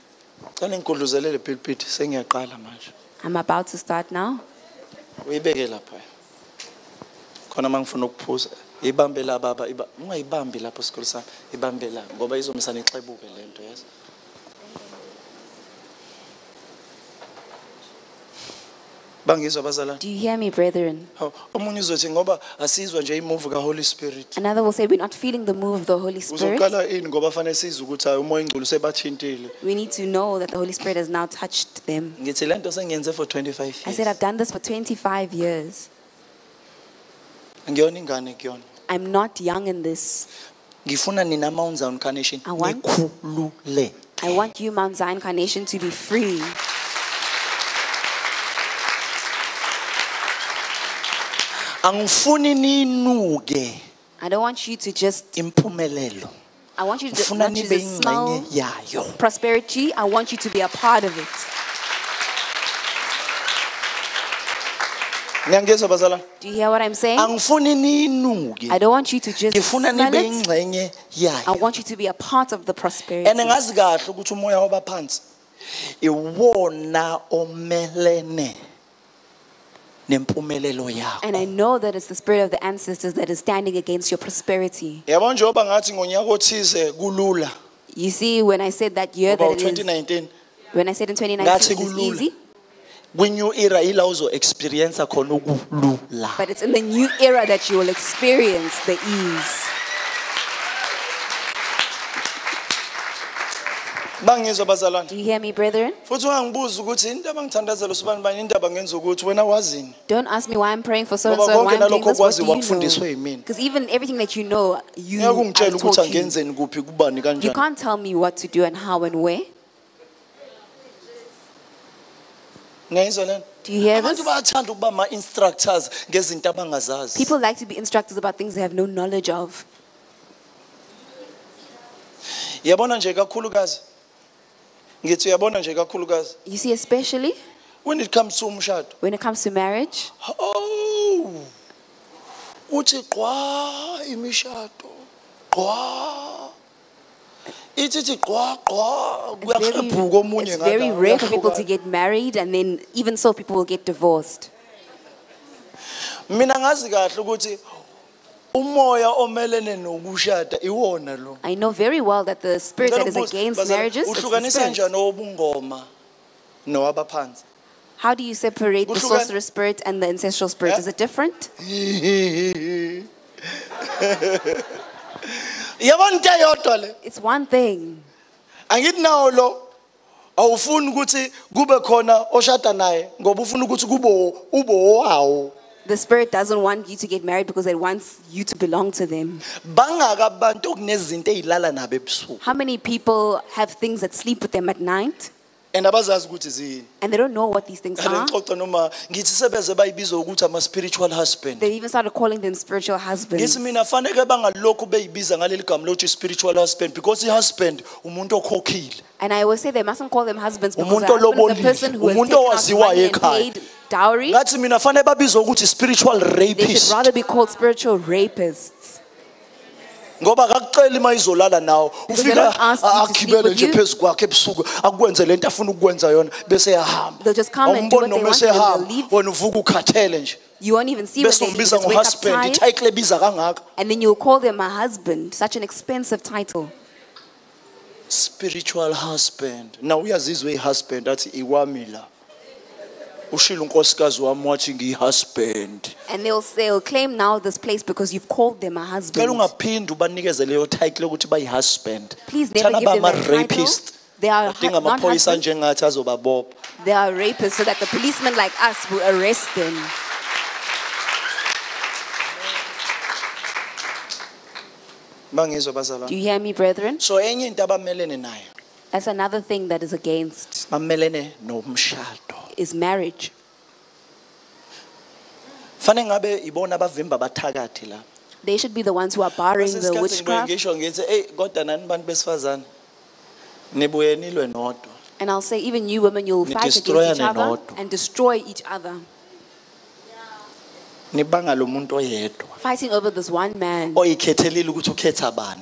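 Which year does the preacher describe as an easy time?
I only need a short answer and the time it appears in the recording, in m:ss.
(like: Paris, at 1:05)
2019, at 1:31.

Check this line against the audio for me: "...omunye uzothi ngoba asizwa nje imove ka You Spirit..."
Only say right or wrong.
wrong.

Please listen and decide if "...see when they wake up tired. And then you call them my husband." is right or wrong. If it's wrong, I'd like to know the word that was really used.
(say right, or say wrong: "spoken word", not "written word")
right.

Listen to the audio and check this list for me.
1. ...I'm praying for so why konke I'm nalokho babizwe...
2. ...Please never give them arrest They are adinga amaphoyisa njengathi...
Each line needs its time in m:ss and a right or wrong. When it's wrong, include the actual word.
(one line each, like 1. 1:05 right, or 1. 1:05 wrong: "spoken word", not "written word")
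1. 1:50 wrong: "wakufundiswe", not "babizwe"
2. 4:12 wrong: "rapist", not "arrest".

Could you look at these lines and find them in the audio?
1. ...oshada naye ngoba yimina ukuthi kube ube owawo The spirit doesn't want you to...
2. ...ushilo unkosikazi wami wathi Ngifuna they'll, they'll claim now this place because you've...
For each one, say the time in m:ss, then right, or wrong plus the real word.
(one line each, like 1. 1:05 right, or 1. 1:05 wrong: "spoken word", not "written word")
1. 3:02 wrong: "ufuna", not "yimina"
2. 4:03 wrong: "And", not "Ngifuna".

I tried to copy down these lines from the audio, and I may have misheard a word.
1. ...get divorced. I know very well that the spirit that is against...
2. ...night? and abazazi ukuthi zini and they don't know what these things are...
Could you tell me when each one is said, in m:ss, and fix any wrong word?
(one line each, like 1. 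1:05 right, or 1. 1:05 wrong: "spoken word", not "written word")
1. 2:33 right
2. 3:14 right.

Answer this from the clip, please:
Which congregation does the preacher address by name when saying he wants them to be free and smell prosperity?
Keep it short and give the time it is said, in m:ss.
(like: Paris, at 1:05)
Mount Zion Carnation, at 0:44.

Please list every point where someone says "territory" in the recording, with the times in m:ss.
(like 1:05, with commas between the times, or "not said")
not said.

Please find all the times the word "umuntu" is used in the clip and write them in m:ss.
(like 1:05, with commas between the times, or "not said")
3:28, 3:32.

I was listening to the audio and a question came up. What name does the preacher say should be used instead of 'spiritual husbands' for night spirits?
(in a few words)
spiritual rapists.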